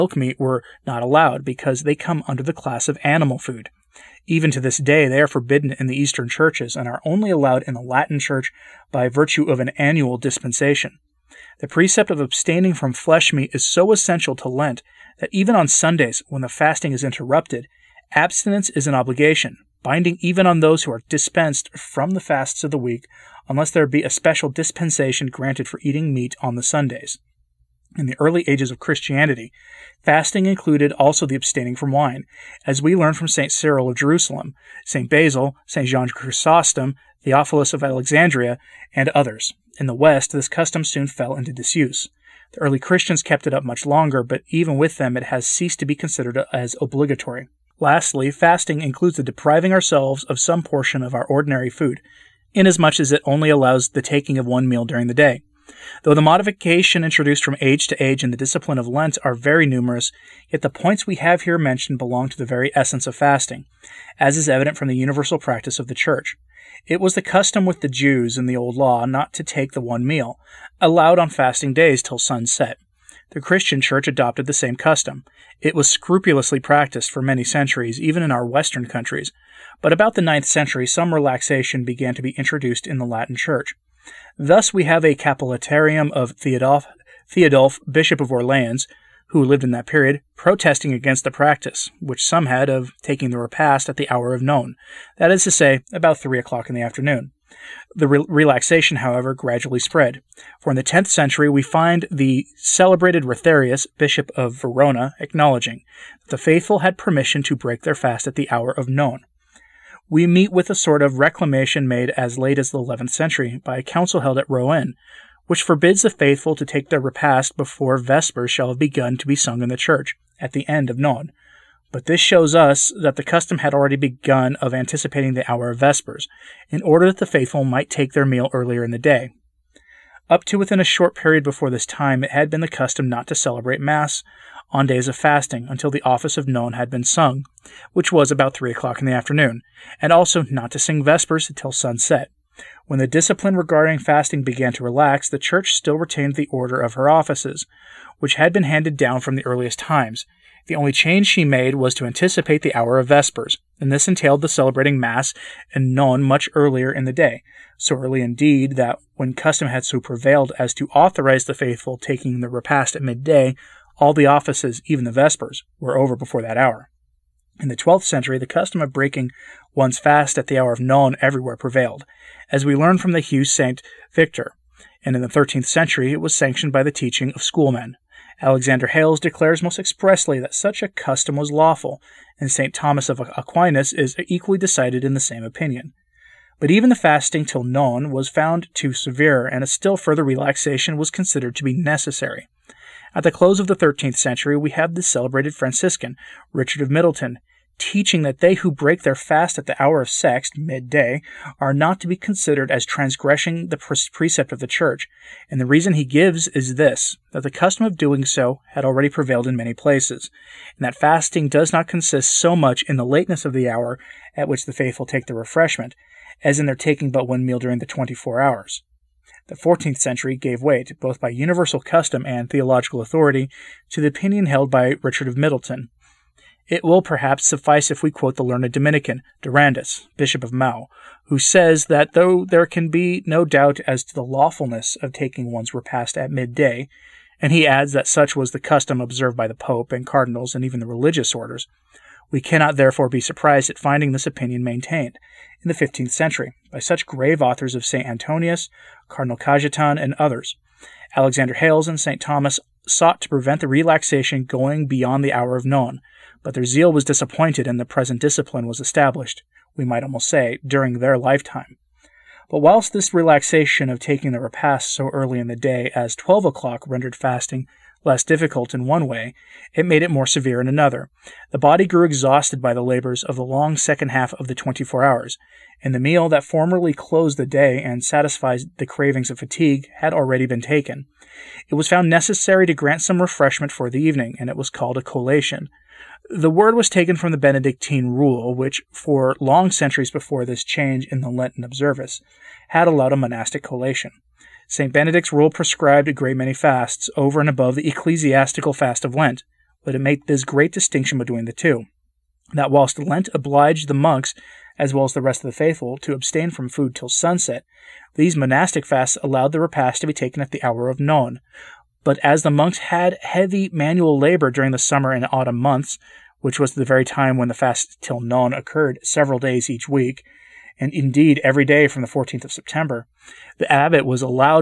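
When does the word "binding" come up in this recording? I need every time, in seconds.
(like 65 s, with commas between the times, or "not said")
19 s.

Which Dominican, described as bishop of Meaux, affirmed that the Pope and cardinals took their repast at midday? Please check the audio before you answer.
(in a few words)
Durandus.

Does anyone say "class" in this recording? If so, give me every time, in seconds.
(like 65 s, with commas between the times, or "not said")
2 s.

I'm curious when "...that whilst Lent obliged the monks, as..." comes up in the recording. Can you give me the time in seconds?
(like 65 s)
302 s.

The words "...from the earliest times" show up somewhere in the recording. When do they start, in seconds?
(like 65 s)
149 s.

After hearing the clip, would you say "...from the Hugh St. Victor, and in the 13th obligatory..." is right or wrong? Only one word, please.
wrong.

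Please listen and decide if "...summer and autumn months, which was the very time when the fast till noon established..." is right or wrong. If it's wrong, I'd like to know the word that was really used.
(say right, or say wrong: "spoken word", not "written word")
wrong: "occurred", not "established".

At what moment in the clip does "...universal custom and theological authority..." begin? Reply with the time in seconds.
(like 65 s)
221 s.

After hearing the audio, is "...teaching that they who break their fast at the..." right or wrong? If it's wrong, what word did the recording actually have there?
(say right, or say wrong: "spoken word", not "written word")
right.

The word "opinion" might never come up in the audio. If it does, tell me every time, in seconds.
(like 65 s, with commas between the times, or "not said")
185 s, 224 s, 244 s.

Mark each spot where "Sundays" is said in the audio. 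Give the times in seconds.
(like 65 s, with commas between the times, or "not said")
15 s, 26 s.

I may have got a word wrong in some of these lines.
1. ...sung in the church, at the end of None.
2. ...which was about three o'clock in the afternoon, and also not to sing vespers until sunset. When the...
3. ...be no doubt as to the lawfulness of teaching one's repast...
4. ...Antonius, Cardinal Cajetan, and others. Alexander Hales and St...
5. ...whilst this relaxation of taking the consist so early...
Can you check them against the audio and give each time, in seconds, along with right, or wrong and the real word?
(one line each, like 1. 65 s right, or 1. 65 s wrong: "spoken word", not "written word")
1. 119 s right
2. 137 s right
3. 232 s wrong: "taking", not "teaching"
4. 248 s right
5. 262 s wrong: "repast", not "consist".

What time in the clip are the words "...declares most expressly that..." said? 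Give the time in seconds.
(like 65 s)
179 s.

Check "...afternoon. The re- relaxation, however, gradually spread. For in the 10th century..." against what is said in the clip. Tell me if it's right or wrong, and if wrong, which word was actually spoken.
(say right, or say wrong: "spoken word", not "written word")
right.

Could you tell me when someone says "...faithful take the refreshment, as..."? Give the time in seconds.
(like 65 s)
214 s.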